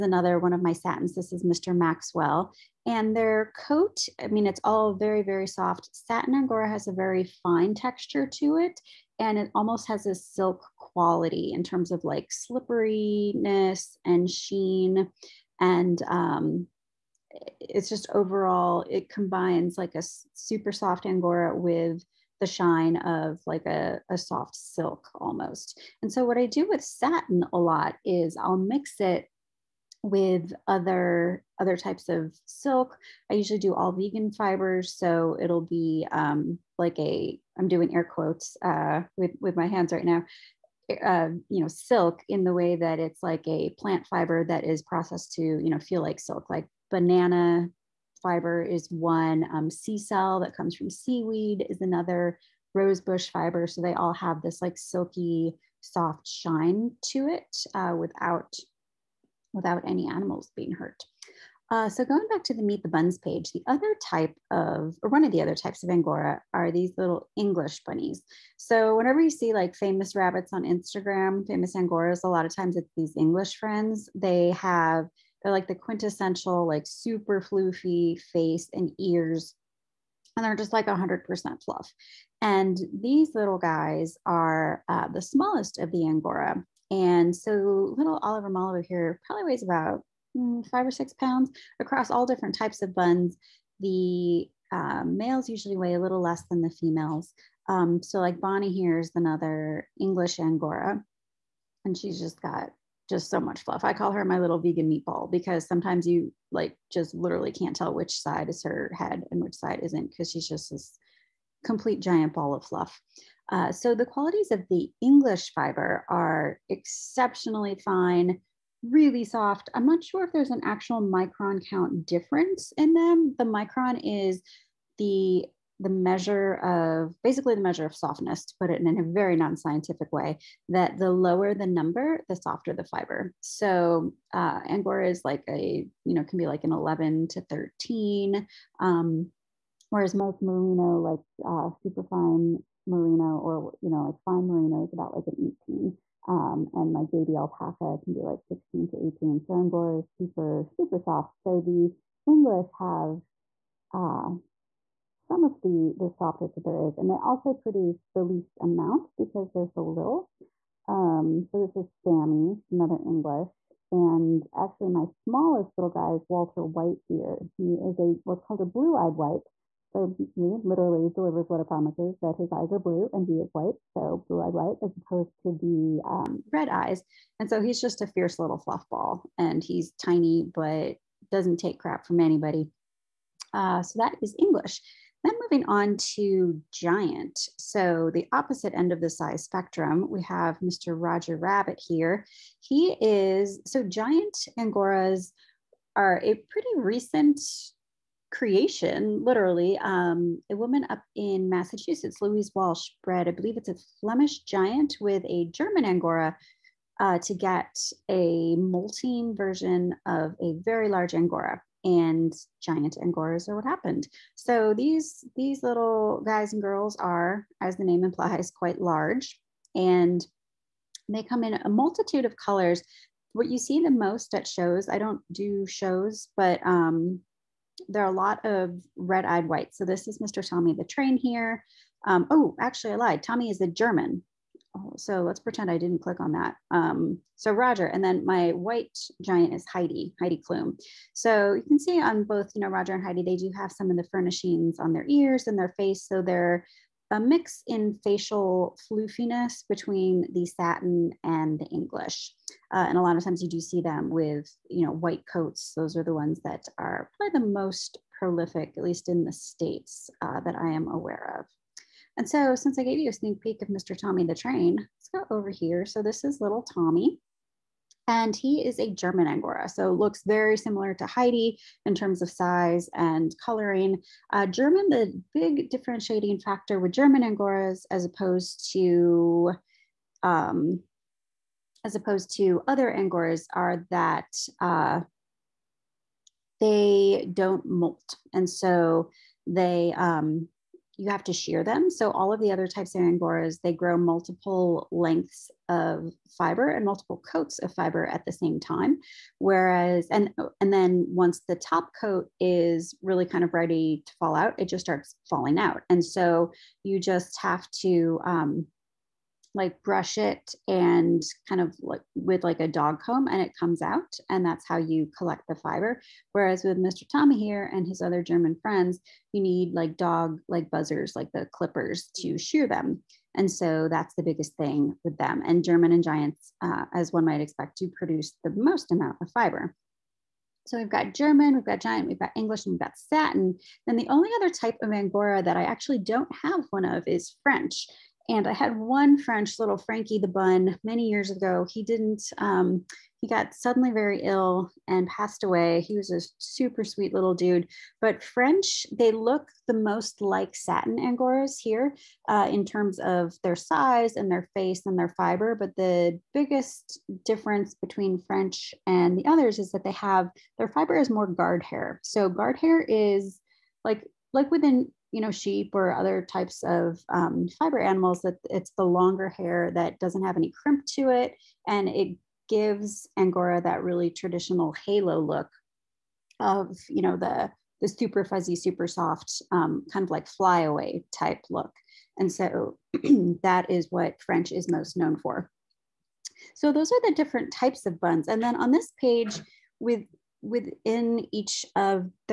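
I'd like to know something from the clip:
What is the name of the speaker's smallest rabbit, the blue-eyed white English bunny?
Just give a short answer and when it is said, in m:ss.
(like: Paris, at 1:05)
Walter White, at 2:46.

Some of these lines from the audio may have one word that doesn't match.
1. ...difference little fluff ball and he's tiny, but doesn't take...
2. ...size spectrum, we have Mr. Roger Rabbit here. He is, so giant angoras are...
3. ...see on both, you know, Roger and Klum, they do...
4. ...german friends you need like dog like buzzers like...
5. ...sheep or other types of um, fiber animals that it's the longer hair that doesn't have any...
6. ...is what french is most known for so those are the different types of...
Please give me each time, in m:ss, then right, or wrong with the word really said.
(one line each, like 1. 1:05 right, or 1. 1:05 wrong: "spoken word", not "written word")
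1. 2:58 wrong: "fierce", not "difference"
2. 3:09 right
3. 4:01 wrong: "Heidi", not "Klum"
4. 5:18 right
5. 6:05 right
6. 6:23 right.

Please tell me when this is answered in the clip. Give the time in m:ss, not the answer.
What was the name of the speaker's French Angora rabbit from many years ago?
5:39.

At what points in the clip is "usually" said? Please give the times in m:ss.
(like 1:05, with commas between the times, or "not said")
0:33, 1:35.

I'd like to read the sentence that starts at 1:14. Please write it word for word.
They have they're like the quintessential, like super floofy face and ears.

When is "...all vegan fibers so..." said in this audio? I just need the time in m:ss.
0:33.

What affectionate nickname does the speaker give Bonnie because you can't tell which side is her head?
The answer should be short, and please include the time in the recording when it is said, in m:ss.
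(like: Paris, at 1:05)
vegan meatball, at 1:44.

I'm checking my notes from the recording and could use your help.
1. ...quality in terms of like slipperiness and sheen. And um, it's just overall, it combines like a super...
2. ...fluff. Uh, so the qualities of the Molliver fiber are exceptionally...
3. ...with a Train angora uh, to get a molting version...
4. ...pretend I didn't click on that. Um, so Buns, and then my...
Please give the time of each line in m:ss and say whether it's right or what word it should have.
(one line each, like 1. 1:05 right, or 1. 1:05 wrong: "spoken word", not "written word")
1. 0:10 right
2. 1:52 wrong: "English", not "Molliver"
3. 3:25 wrong: "German", not "Train"
4. 3:55 wrong: "Roger", not "Buns".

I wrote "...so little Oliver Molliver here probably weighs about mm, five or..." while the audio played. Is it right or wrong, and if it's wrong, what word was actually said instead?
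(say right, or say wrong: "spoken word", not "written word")
right.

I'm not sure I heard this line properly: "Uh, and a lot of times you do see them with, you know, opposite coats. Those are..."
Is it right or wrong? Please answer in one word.
wrong.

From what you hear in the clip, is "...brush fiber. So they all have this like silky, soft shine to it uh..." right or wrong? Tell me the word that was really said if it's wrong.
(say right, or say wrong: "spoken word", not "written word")
wrong: "rosebush", not "brush".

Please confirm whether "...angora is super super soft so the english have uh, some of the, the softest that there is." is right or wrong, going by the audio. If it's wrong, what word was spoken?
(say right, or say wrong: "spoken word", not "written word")
right.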